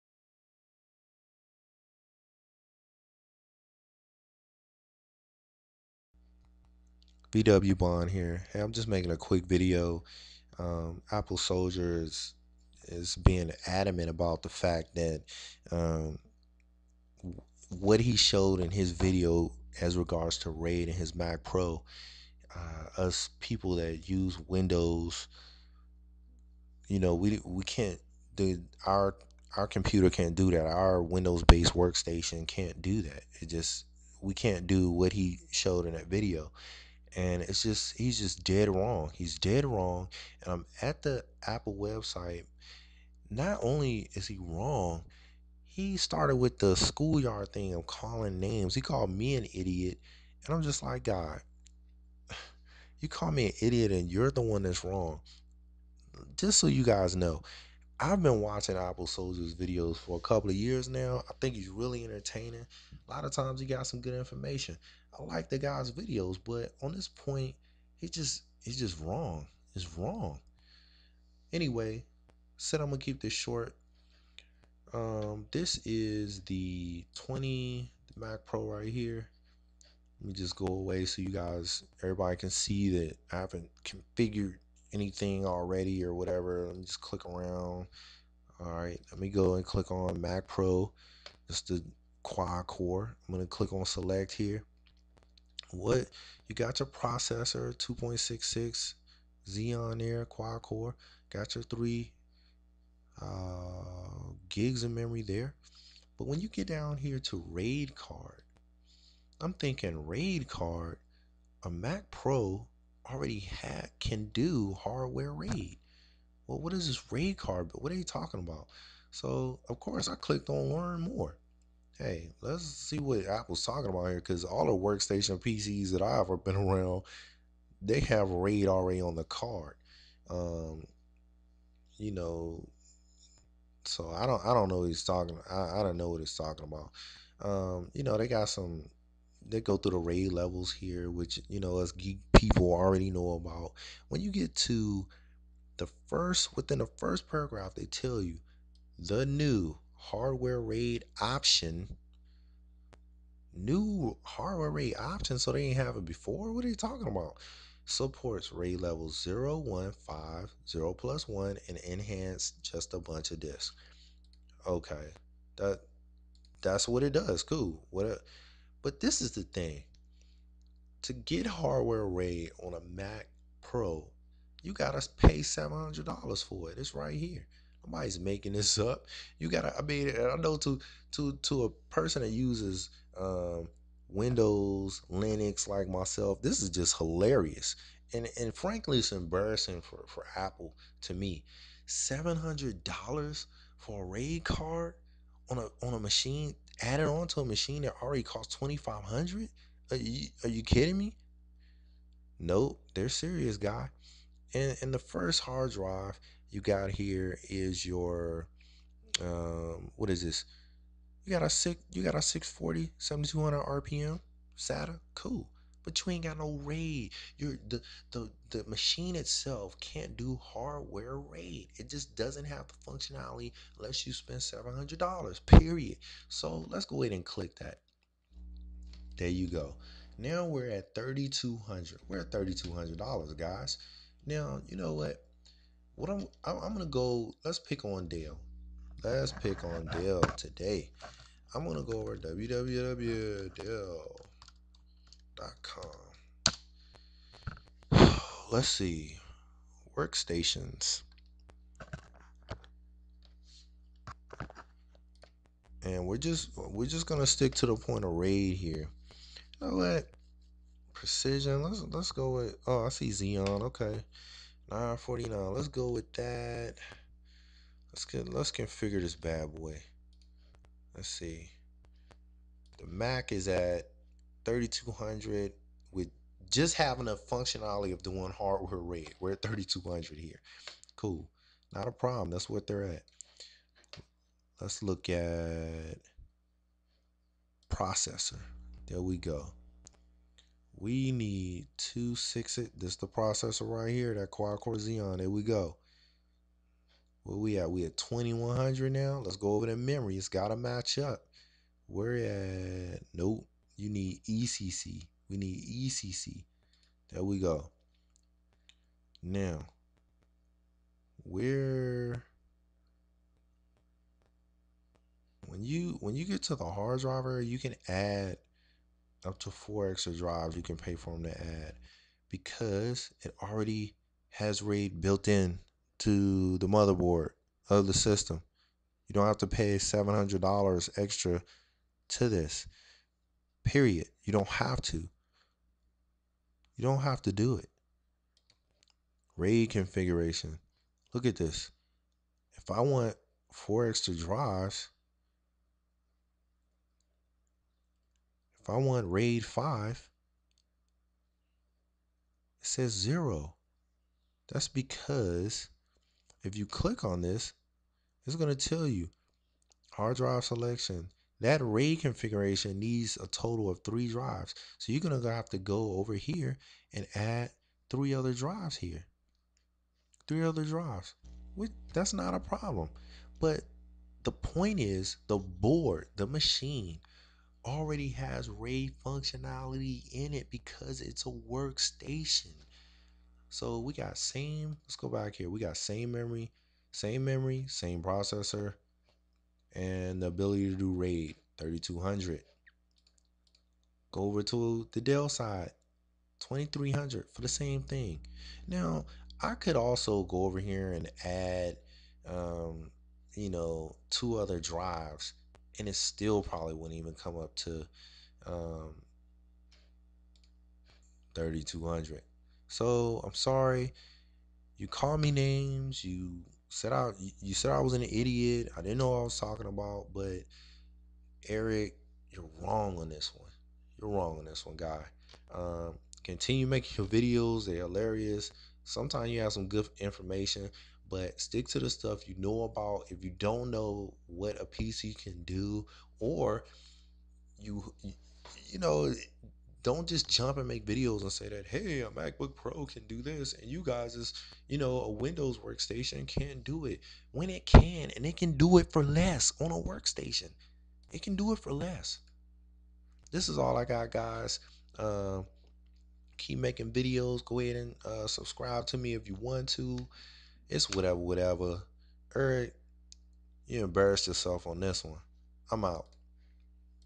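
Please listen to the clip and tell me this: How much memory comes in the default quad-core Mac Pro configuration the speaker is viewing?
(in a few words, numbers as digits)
3 gigs.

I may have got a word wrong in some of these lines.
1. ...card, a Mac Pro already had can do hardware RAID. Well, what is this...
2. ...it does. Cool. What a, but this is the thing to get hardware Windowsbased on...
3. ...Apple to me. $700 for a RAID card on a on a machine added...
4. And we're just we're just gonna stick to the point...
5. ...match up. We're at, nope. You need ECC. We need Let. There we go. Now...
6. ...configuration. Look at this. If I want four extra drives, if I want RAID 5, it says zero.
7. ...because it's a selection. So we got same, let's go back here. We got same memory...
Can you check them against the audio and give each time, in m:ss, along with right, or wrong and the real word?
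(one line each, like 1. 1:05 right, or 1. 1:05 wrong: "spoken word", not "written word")
1. 1:50 right
2. 2:47 wrong: "RAID", not "Windowsbased"
3. 3:10 right
4. 4:15 right
5. 5:00 wrong: "ECC", not "Let"
6. 5:39 right
7. 6:20 wrong: "workstation", not "selection".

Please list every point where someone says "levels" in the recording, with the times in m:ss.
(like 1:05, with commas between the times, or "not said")
2:20, 2:38.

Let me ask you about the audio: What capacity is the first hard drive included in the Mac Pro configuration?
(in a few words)
640.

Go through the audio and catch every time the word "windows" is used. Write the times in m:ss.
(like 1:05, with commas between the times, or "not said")
0:24, 0:31, 3:04, 7:25.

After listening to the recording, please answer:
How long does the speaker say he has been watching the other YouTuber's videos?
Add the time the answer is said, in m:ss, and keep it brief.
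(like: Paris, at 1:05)
a couple of years, at 1:00.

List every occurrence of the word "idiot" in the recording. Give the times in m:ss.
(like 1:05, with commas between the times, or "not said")
0:49, 0:53, 6:58.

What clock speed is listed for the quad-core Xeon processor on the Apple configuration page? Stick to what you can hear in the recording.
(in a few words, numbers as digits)
2.66.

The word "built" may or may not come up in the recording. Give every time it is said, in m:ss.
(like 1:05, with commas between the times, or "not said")
5:25.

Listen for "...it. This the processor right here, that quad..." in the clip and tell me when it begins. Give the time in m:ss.
4:52.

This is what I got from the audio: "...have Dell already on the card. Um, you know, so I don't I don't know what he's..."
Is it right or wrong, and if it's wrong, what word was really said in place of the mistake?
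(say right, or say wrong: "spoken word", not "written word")
wrong: "RAID", not "Dell".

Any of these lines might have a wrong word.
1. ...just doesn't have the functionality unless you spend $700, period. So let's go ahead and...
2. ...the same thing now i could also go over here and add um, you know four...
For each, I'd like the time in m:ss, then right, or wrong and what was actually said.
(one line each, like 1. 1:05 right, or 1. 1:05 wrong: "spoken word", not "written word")
1. 3:41 right
2. 6:37 wrong: "two", not "four".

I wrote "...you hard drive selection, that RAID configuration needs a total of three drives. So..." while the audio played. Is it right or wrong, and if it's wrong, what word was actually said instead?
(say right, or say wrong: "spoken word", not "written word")
right.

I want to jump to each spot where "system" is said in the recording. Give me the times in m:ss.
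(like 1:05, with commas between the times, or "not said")
5:27.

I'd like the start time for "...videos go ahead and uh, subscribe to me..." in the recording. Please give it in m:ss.
7:36.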